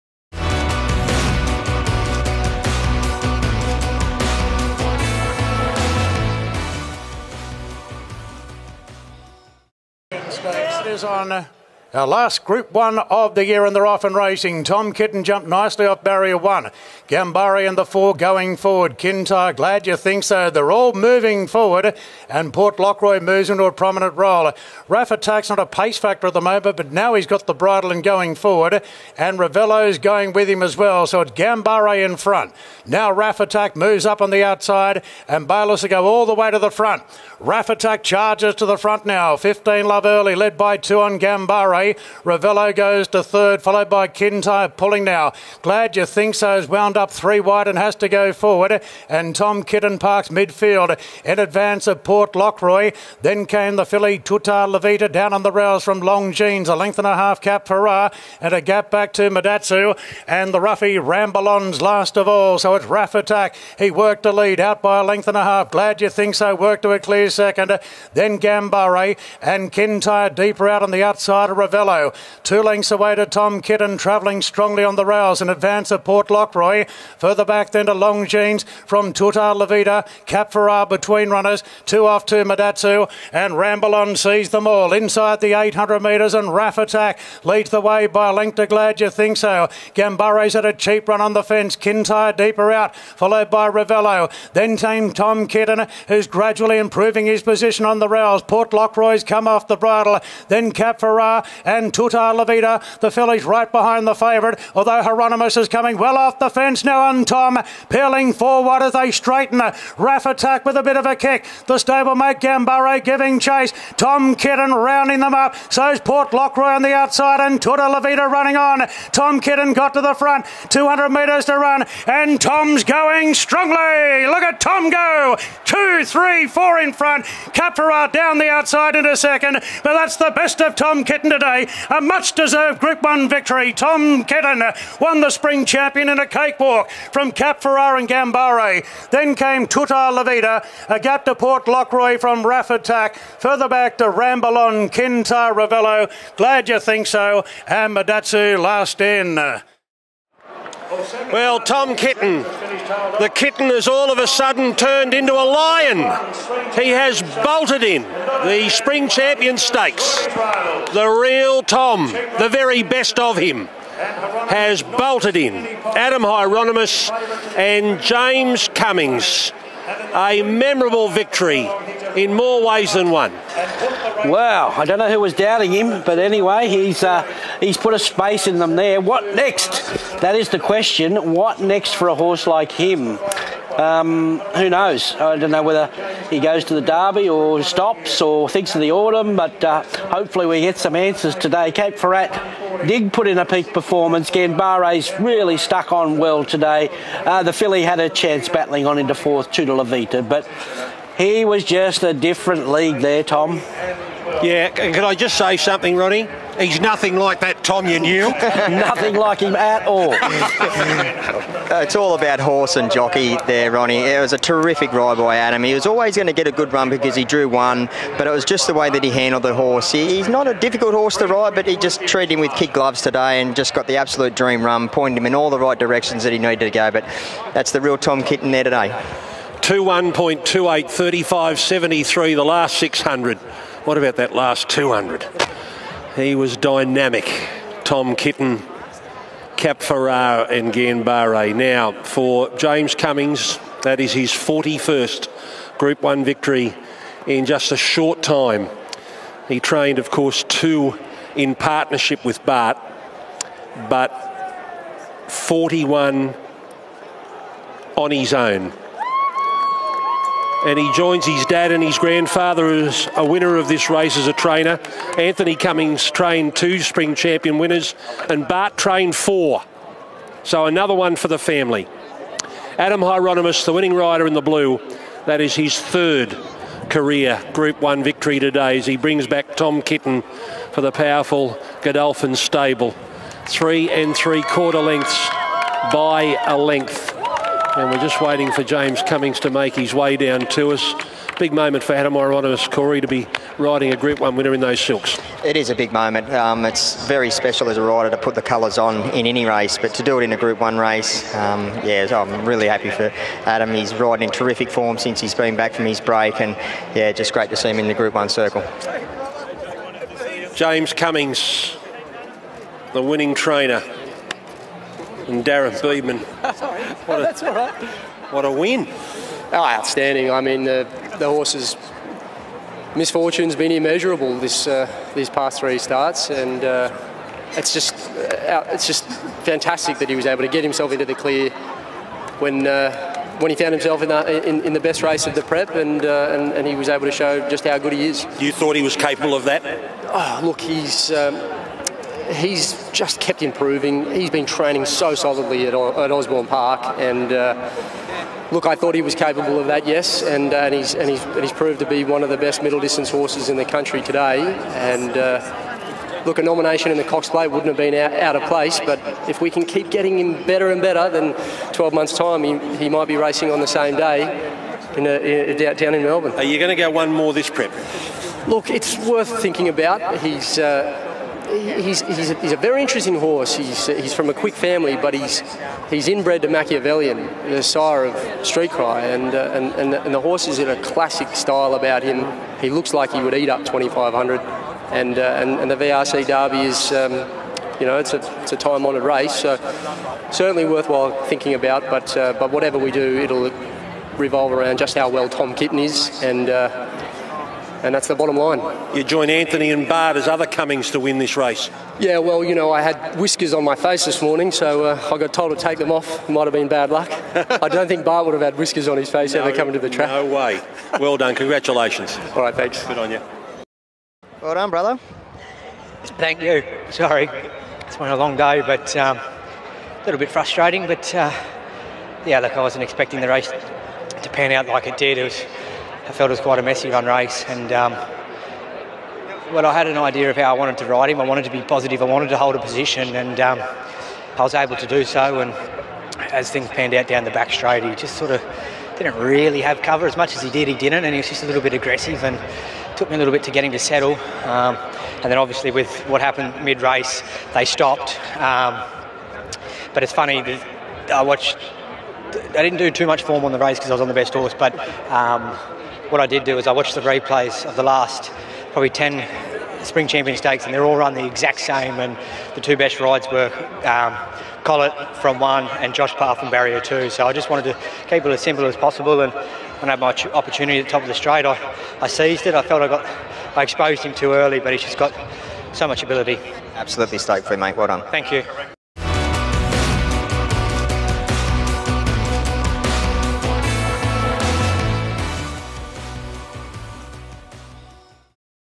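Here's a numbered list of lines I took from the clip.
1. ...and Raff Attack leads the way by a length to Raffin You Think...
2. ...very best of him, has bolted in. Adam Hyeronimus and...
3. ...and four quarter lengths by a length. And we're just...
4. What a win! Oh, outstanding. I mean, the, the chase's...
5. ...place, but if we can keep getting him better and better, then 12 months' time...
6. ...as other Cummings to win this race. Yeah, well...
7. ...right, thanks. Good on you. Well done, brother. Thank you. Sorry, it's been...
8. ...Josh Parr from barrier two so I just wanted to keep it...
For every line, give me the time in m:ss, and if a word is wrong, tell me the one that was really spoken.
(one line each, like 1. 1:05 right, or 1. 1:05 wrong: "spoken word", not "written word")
1. 1:26 wrong: "Glad", not "Raffin"
2. 2:42 right
3. 4:43 wrong: "three", not "four"
4. 5:18 wrong: "horse", not "chase"
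5. 5:58 right
6. 6:40 right
7. 6:52 right
8. 7:45 right.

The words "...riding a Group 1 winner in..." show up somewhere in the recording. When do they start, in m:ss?
4:53.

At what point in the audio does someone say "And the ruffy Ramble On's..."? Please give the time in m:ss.
1:00.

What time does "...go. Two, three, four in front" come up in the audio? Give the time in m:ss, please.
2:04.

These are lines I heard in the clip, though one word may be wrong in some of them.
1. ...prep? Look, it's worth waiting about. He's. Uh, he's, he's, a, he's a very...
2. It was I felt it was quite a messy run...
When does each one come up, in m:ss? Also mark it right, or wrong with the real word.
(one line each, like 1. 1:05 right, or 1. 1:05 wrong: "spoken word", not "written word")
1. 6:07 wrong: "thinking", not "waiting"
2. 7:05 right.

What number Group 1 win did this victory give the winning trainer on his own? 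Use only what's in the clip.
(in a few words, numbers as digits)
41st.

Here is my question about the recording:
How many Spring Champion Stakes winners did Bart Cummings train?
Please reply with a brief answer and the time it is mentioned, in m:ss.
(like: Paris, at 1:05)
4, at 4:28.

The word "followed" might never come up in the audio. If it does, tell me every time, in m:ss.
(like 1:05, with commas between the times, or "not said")
0:43, 1:32.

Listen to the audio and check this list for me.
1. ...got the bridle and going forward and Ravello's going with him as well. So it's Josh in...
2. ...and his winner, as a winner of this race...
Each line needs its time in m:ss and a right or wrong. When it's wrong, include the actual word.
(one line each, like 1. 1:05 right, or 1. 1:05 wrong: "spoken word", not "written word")
1. 0:27 wrong: "Ganbare", not "Josh"
2. 4:21 wrong: "grandfather", not "winner".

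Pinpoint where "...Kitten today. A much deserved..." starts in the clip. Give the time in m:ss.
2:11.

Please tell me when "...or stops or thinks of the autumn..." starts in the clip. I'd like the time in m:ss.
3:07.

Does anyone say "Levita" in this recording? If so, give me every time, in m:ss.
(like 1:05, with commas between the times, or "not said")
0:54, 1:19, 1:42, 1:57, 2:20.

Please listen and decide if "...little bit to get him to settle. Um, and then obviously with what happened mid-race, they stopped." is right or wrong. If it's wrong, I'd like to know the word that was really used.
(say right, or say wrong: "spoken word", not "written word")
right.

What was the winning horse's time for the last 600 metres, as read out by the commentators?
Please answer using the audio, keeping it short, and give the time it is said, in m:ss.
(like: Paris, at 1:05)
35.73, at 3:50.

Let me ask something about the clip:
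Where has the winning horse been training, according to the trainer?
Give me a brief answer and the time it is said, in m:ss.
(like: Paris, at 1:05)
Osborne Park, at 5:46.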